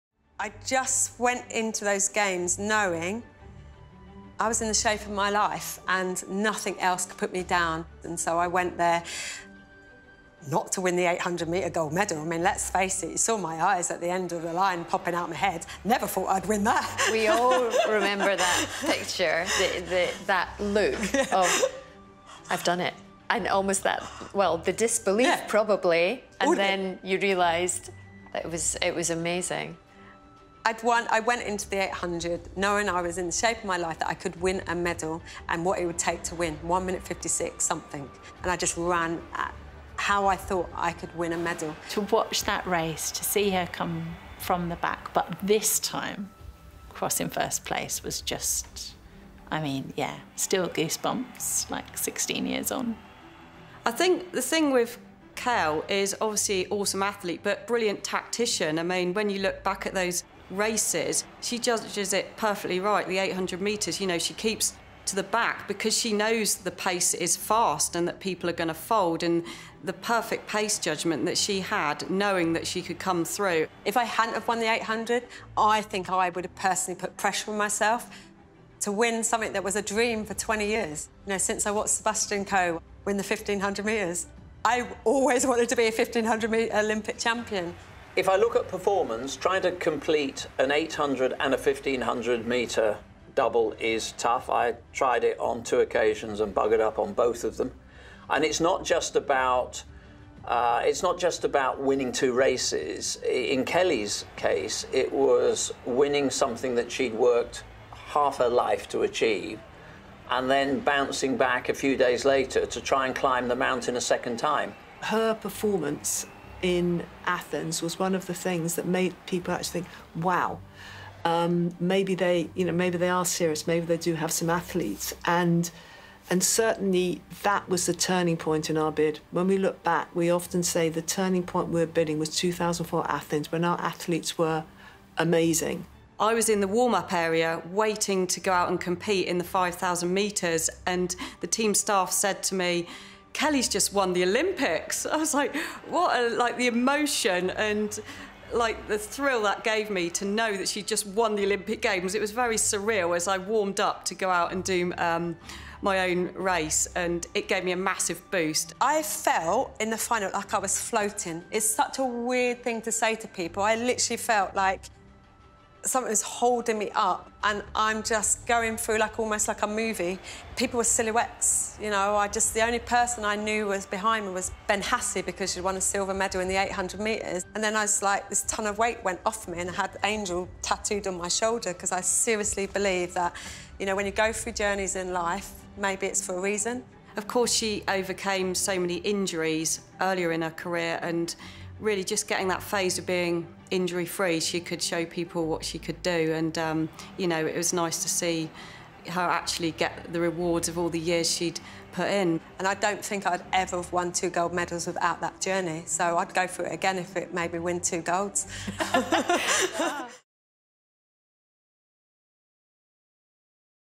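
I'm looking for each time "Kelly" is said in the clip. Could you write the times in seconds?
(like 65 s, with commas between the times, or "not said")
103 s, 143 s.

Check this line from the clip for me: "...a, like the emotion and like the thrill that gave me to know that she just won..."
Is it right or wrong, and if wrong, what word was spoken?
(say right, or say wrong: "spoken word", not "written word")
right.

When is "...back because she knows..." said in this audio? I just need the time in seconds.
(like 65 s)
65 s.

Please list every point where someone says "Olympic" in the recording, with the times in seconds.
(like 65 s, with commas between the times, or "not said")
86 s, 144 s, 151 s.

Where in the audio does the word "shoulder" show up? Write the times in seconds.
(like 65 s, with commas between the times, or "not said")
181 s.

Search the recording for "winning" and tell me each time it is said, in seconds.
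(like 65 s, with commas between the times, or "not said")
101 s, 105 s.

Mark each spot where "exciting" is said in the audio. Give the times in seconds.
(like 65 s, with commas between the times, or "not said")
not said.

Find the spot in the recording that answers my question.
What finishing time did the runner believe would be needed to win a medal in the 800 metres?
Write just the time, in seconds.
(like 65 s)
36 s.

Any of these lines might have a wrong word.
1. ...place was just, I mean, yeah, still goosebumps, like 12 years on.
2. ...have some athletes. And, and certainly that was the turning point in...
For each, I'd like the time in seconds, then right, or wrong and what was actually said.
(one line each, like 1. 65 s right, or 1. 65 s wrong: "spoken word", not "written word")
1. 47 s wrong: "16", not "12"
2. 124 s right.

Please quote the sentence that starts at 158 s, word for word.
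I felt in the final like I was floating.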